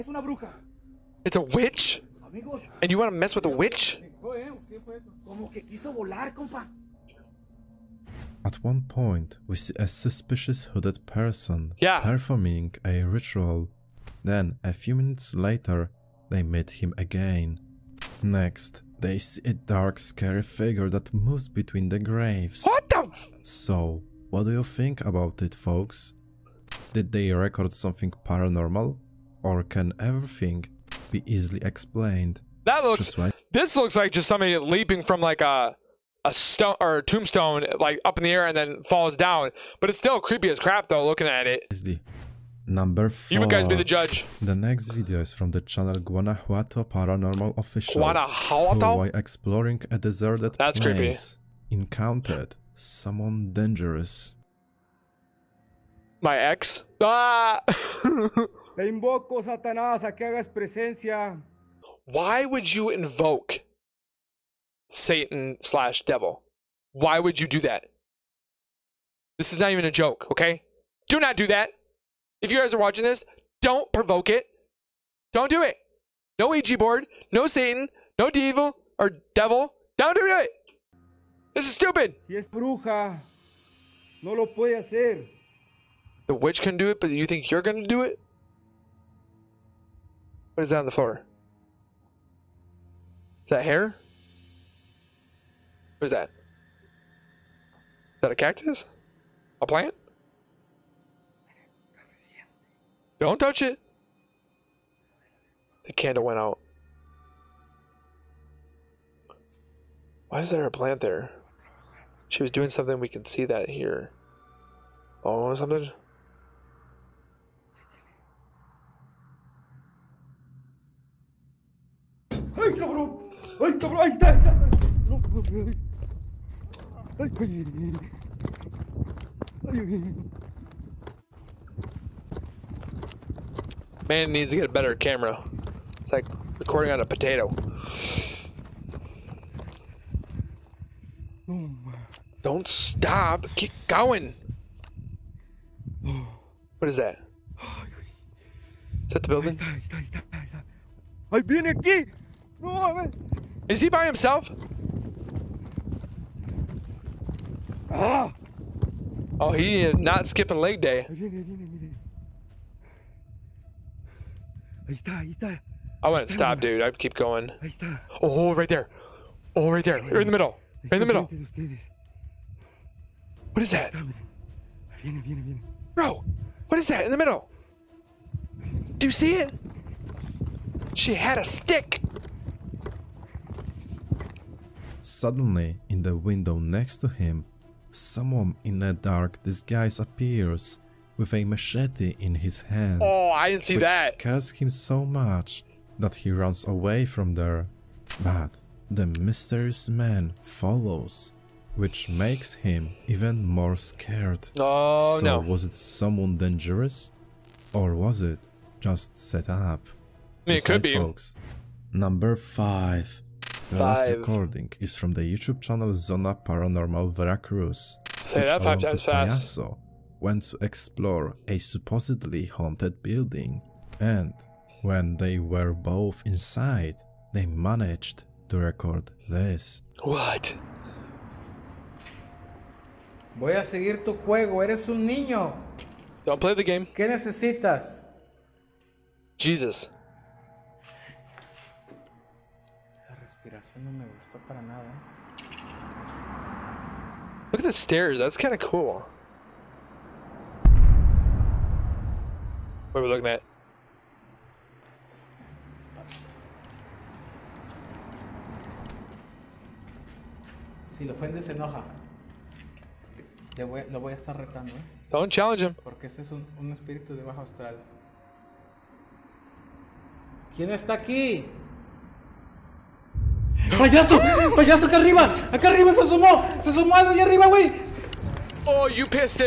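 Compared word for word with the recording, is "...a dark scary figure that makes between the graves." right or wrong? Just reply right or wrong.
wrong.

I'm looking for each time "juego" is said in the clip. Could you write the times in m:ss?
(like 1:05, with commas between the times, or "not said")
3:54.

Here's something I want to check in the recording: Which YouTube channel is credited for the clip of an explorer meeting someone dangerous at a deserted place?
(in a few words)
Guanajuato Paranormal Official.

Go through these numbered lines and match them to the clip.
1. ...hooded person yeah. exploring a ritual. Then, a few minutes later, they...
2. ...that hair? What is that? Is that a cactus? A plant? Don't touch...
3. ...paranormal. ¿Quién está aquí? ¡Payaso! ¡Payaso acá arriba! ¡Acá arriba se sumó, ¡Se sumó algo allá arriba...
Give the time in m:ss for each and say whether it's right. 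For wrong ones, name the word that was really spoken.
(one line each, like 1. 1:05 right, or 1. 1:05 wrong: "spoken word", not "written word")
1. 0:10 wrong: "performing", not "exploring"
2. 1:33 right
3. 4:27 wrong: "austral", not "paranormal".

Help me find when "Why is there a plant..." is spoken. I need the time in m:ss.
1:50.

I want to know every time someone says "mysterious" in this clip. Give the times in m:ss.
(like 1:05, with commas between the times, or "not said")
3:19.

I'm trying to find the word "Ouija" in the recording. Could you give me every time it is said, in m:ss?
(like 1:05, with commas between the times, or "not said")
1:16.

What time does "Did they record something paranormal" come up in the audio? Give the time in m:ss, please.
0:26.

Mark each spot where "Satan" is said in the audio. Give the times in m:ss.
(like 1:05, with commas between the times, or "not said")
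1:04, 1:17.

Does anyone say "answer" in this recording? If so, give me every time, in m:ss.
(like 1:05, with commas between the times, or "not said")
not said.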